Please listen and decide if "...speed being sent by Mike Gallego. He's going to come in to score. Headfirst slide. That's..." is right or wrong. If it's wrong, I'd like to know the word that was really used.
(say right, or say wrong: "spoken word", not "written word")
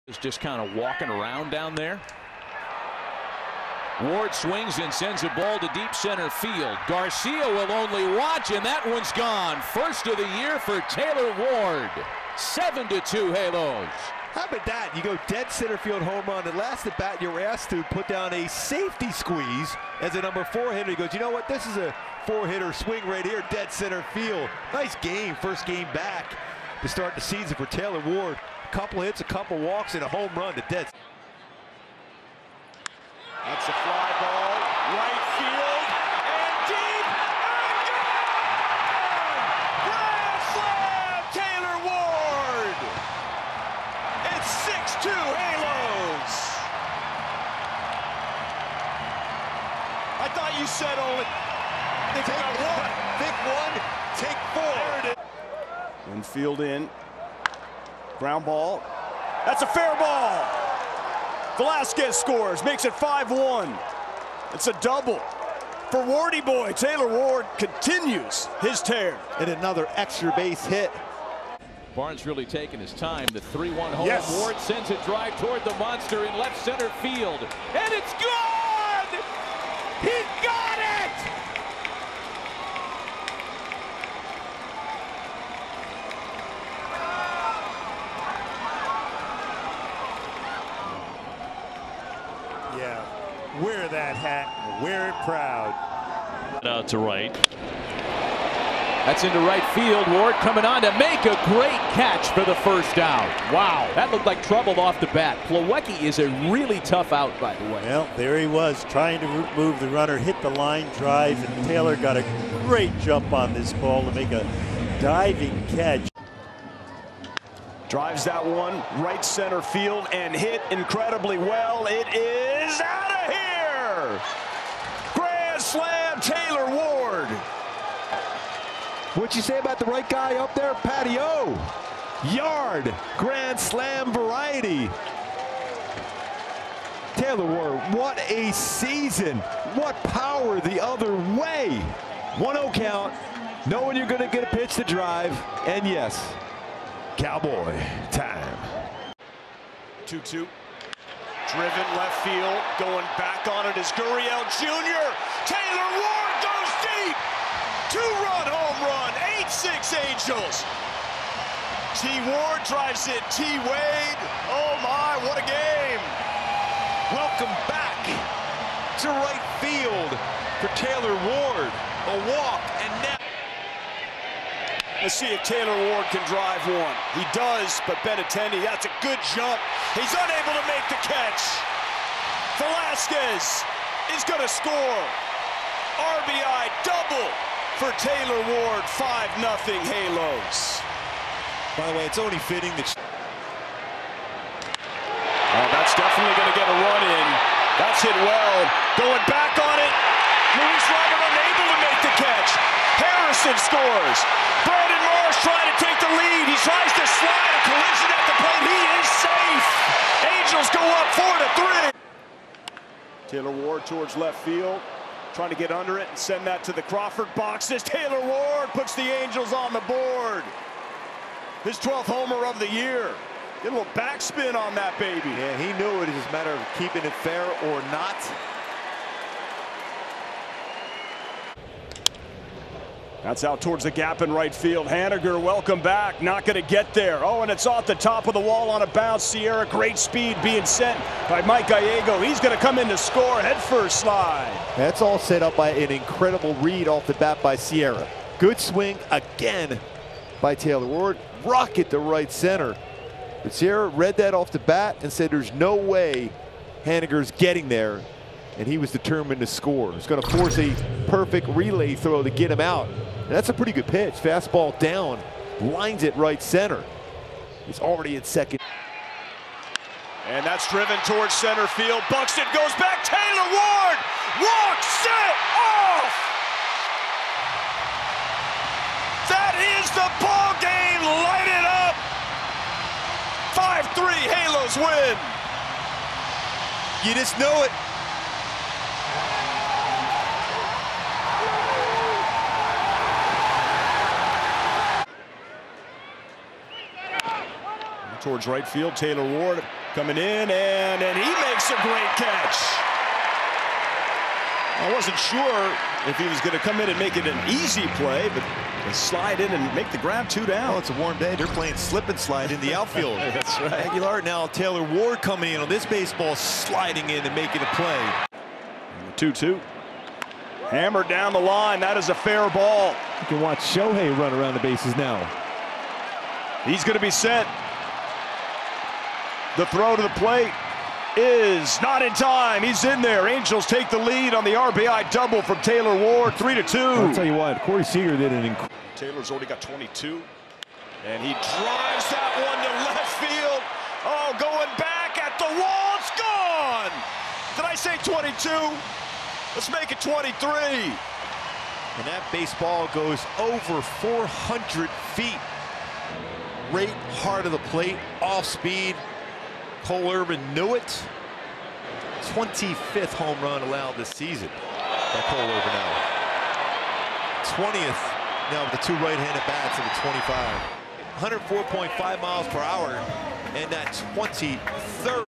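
right.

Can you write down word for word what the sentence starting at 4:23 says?
And that's a pretty good pitch.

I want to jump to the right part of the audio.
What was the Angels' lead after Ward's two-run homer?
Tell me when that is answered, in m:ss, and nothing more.
2:39.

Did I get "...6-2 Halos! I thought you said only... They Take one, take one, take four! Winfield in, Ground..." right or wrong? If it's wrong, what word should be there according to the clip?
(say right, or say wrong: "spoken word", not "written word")
right.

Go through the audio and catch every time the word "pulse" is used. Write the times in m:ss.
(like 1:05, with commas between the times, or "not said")
not said.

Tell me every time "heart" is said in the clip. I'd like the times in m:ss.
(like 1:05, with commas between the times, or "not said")
5:57.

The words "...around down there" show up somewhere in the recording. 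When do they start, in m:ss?
0:01.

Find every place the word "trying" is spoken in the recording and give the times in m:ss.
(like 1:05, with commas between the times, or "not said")
1:48, 3:25, 3:35.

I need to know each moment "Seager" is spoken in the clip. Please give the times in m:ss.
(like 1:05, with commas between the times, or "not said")
5:37.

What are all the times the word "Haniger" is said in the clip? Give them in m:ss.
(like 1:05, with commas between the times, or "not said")
3:54, 4:16.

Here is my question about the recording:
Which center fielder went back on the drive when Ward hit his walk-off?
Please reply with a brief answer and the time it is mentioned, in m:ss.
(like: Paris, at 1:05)
Buxton, at 4:32.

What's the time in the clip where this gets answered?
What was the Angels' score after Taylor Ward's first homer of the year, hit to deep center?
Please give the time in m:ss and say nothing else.
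0:12.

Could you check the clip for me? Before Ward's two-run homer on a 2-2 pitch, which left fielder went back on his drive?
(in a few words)
Gurriel Jr.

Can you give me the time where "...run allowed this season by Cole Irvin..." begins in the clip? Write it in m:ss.
6:03.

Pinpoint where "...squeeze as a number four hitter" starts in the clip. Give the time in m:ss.
0:19.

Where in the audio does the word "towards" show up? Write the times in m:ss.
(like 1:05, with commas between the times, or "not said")
1:15, 3:33, 3:53, 4:31, 4:58.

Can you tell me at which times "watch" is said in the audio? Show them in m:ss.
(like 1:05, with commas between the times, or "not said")
0:08, 5:23.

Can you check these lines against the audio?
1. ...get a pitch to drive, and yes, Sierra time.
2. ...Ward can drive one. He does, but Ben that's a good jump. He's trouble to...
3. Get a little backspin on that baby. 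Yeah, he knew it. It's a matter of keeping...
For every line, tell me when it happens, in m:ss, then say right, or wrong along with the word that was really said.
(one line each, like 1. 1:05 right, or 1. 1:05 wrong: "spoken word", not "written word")
1. 2:24 wrong: "Cowboy", not "Sierra"
2. 2:55 wrong: "unable", not "trouble"
3. 3:43 right.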